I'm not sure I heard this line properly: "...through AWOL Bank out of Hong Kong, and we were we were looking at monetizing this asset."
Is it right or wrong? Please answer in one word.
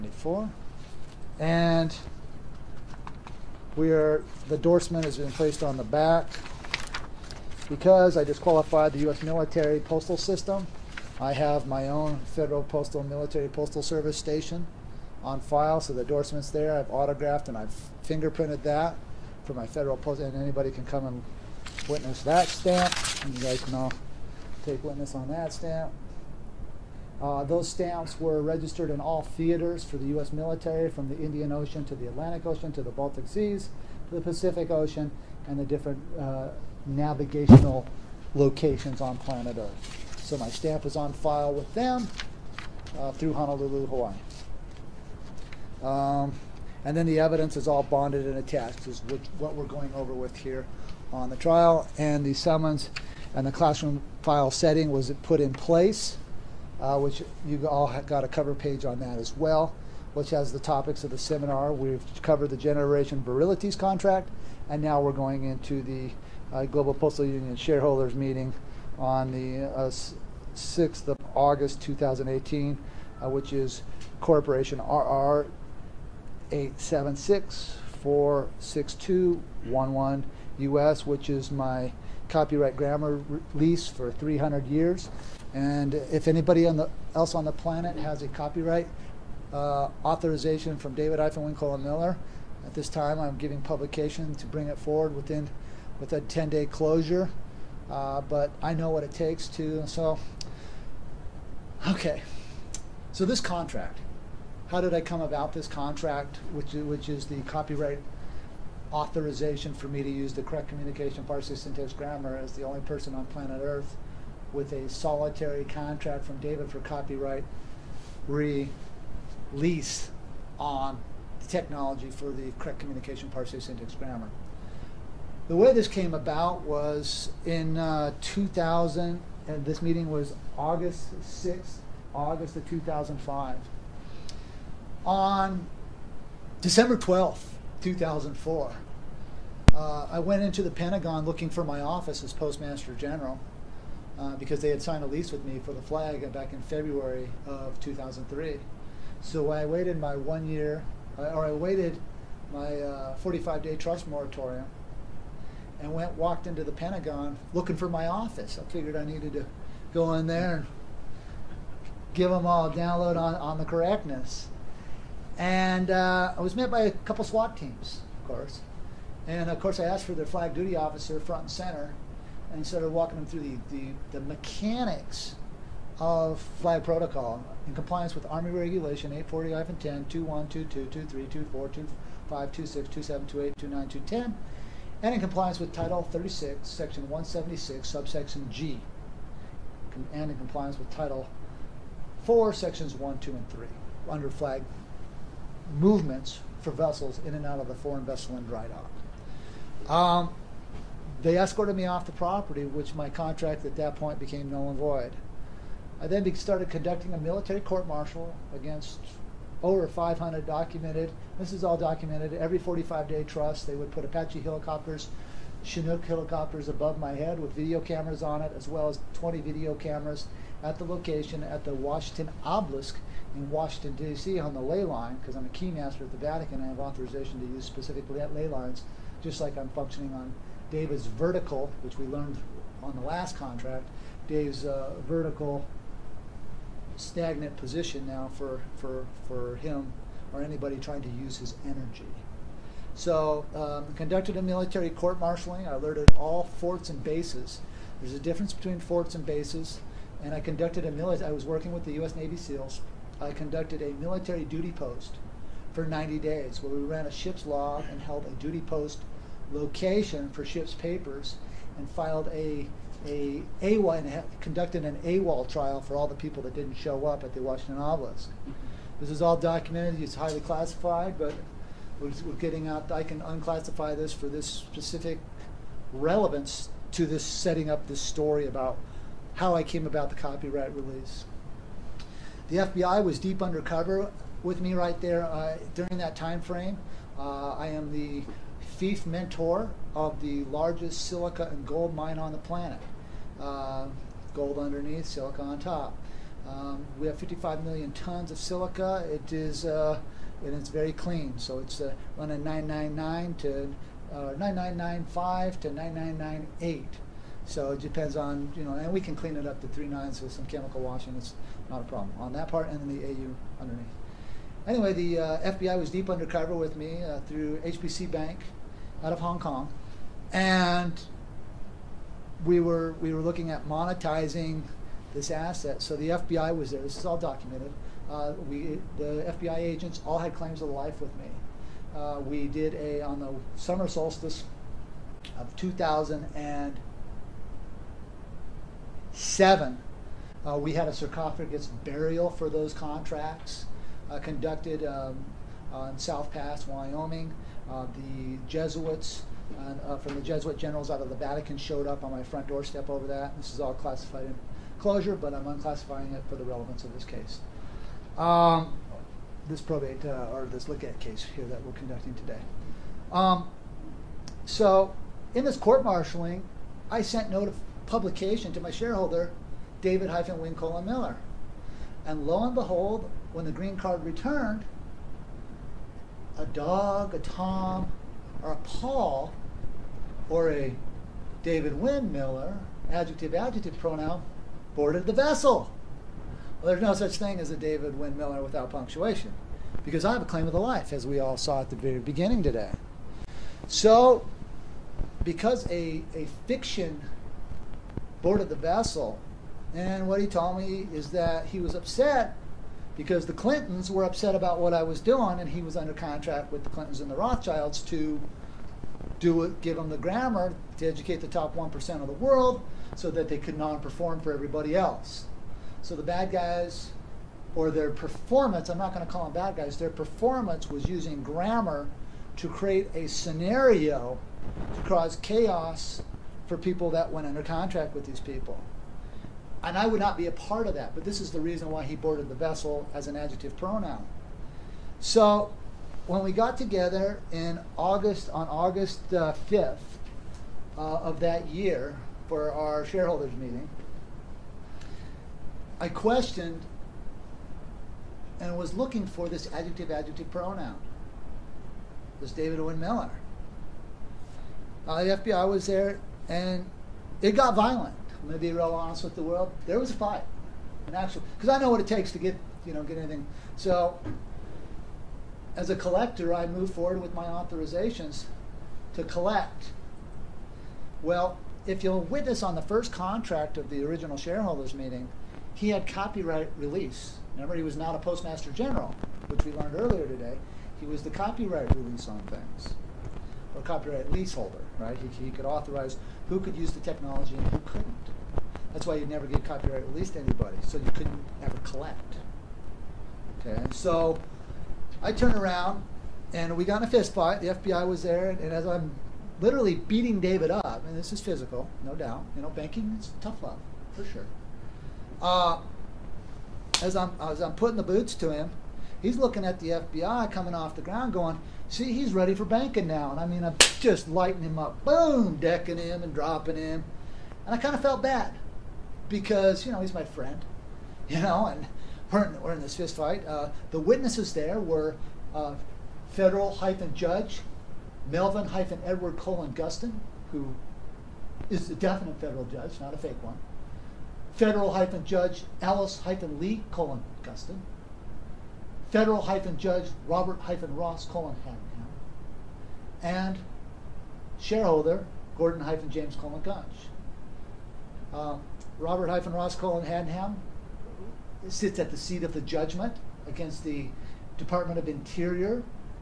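wrong.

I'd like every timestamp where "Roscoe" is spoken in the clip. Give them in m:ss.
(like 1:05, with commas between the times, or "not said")
9:09.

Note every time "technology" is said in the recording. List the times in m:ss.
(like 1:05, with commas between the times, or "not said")
2:01, 8:06.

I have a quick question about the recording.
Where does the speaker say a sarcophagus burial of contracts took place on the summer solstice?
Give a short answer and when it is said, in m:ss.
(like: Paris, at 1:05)
South Pass, Wyoming, at 5:45.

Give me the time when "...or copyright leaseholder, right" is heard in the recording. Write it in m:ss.
8:03.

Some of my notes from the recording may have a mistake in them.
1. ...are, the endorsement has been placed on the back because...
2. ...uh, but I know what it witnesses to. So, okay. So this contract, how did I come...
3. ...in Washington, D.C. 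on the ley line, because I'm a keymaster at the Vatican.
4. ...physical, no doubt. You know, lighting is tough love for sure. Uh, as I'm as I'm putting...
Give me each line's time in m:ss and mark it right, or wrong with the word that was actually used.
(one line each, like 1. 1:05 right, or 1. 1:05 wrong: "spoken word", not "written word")
1. 0:03 right
2. 1:37 wrong: "takes", not "witnesses"
3. 3:43 right
4. 8:21 wrong: "banking", not "lighting".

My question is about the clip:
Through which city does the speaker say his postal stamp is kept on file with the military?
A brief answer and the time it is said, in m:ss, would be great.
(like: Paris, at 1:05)
Honolulu, Hawaii, at 0:43.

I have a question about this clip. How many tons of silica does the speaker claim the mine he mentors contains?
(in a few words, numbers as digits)
55 million tons.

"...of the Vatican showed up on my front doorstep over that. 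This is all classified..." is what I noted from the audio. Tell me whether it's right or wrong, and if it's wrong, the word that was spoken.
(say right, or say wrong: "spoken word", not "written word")
right.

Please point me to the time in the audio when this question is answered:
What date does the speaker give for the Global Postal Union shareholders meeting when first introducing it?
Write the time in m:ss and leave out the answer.
1:10.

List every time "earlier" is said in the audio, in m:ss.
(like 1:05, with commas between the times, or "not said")
7:59.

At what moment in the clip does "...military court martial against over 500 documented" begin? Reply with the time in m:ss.
3:27.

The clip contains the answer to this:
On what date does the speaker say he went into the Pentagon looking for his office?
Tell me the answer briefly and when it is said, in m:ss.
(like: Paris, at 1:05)
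December 12th, 2004, at 2:16.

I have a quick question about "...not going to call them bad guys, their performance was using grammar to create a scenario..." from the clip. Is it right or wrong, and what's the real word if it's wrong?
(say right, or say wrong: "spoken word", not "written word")
right.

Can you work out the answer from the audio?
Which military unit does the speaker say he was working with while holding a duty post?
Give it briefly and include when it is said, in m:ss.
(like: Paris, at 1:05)
U.S. Navy SEALs, at 4:11.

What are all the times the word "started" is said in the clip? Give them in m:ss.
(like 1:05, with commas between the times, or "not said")
2:52, 3:26.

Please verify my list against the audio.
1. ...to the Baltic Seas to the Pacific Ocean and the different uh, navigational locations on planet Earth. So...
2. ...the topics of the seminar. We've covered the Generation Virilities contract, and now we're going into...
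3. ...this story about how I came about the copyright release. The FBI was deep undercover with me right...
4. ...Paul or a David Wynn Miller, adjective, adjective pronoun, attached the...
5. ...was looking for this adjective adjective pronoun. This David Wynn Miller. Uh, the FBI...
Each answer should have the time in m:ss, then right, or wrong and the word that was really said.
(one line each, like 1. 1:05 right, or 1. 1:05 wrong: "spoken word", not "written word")
1. 0:32 right
2. 1:00 right
3. 4:37 right
4. 6:18 wrong: "boarded", not "attached"
5. 7:28 right.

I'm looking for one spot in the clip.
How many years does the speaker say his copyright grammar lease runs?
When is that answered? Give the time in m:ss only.
1:24.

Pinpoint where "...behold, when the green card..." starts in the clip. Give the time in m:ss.
6:12.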